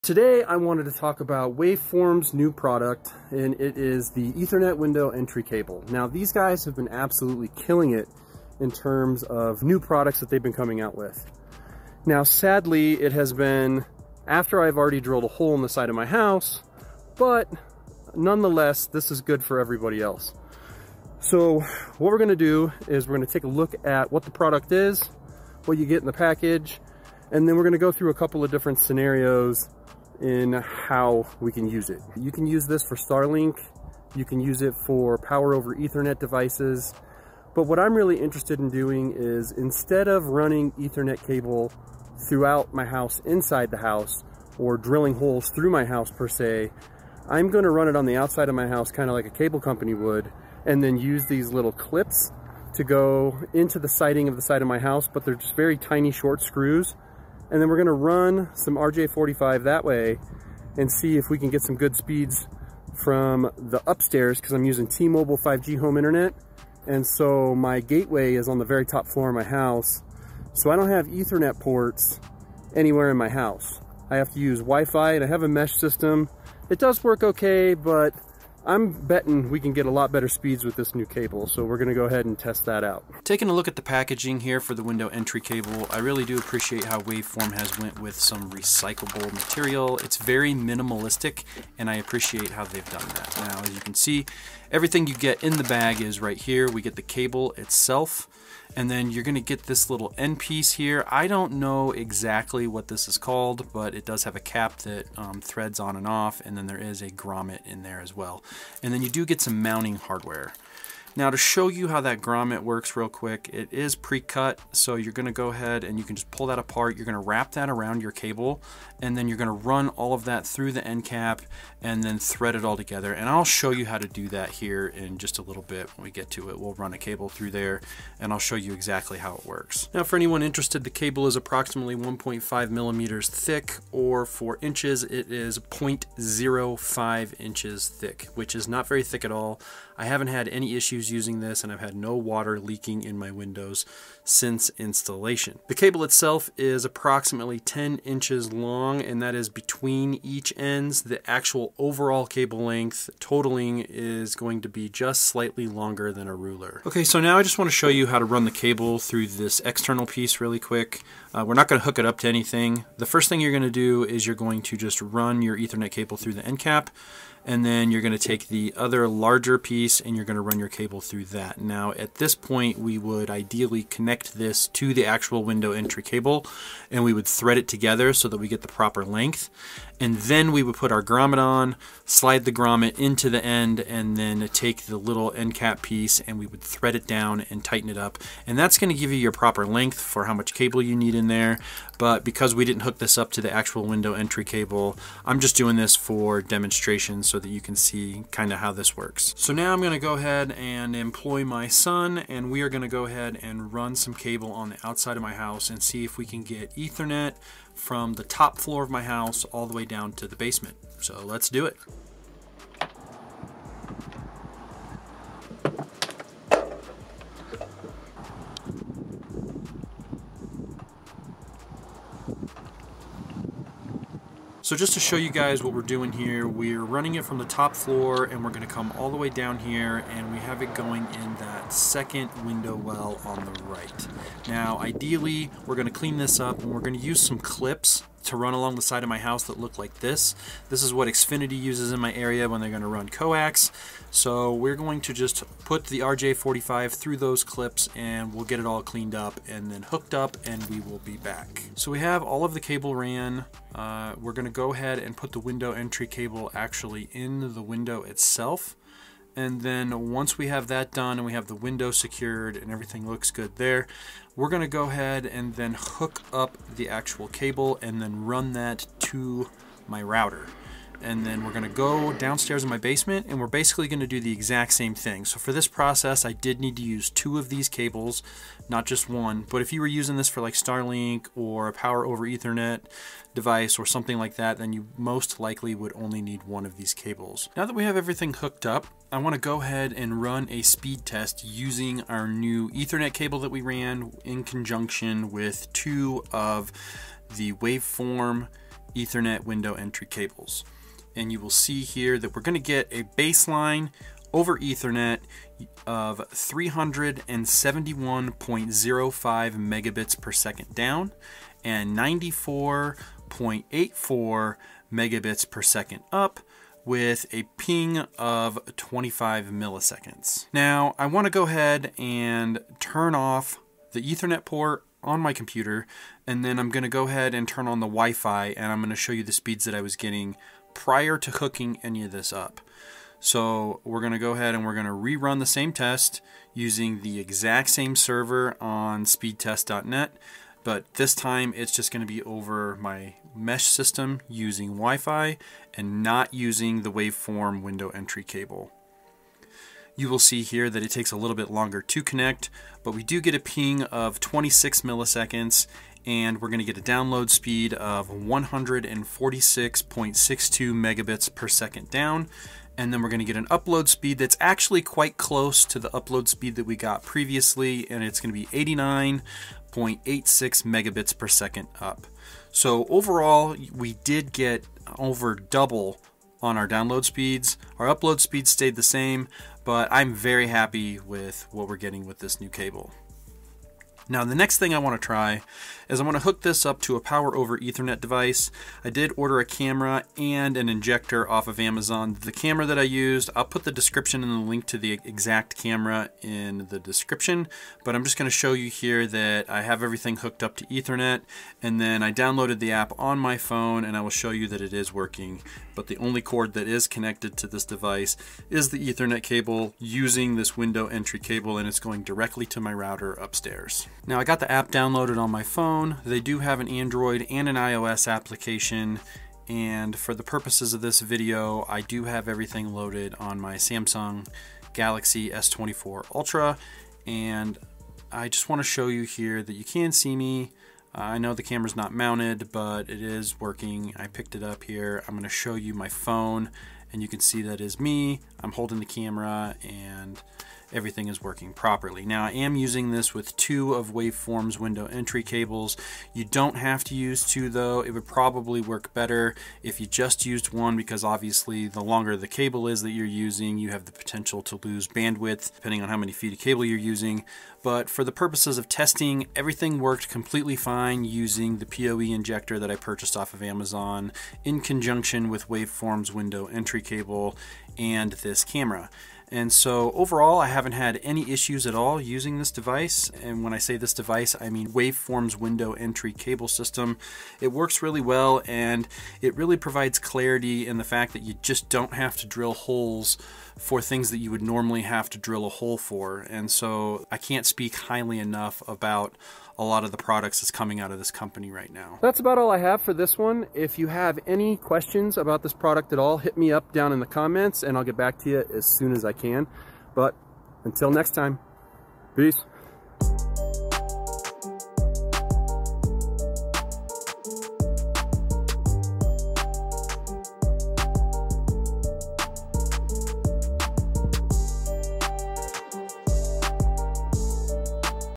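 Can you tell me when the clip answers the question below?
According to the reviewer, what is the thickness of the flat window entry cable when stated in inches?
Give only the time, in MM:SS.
02:15.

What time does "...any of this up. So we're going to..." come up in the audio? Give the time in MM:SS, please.
05:31.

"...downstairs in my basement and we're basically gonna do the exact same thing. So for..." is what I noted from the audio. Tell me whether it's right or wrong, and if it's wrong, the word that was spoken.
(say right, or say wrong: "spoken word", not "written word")
right.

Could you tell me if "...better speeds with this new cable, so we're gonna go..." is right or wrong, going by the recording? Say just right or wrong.
right.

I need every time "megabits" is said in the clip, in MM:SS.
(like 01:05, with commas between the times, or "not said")
05:09, 05:14, 06:00, 06:10.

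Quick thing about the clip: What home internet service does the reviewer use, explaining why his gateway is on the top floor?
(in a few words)
T-Mobile 5G home internet.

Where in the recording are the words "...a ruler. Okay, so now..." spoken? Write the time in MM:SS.
02:36.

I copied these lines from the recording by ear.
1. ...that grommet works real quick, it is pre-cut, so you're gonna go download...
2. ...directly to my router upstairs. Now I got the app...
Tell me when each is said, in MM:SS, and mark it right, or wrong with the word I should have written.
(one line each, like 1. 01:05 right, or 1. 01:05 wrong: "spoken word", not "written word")
1. 01:52 wrong: "ahead", not "download"
2. 06:52 right.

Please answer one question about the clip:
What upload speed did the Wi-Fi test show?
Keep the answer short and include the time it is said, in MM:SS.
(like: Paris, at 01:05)
89.86 Mbps, at 06:08.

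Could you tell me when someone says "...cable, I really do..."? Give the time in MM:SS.
01:25.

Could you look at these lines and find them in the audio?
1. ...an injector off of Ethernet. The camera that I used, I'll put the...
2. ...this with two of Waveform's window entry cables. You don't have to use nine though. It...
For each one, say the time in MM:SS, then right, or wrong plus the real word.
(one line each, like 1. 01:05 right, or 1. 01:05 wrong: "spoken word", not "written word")
1. 06:30 wrong: "Amazon", not "Ethernet"
2. 07:22 wrong: "two", not "nine".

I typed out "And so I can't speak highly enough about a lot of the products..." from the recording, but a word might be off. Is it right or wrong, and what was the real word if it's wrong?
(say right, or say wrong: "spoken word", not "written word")
right.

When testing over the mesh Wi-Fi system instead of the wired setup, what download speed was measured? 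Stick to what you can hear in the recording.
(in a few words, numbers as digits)
146.62 Mbps.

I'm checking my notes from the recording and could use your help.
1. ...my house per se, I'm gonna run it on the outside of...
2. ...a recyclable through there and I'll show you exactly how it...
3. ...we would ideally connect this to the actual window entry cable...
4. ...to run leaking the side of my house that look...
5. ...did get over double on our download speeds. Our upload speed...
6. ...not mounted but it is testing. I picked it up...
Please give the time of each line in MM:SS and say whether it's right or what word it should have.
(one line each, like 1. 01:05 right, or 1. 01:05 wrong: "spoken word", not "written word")
1. 00:45 right
2. 02:06 wrong: "cable", not "recyclable"
3. 02:52 right
4. 03:58 wrong: "along", not "leaking"
5. 06:14 right
6. 07:11 wrong: "working", not "testing".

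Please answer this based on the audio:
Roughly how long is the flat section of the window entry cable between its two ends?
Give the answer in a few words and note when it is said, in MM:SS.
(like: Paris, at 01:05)
10 inches, at 02:27.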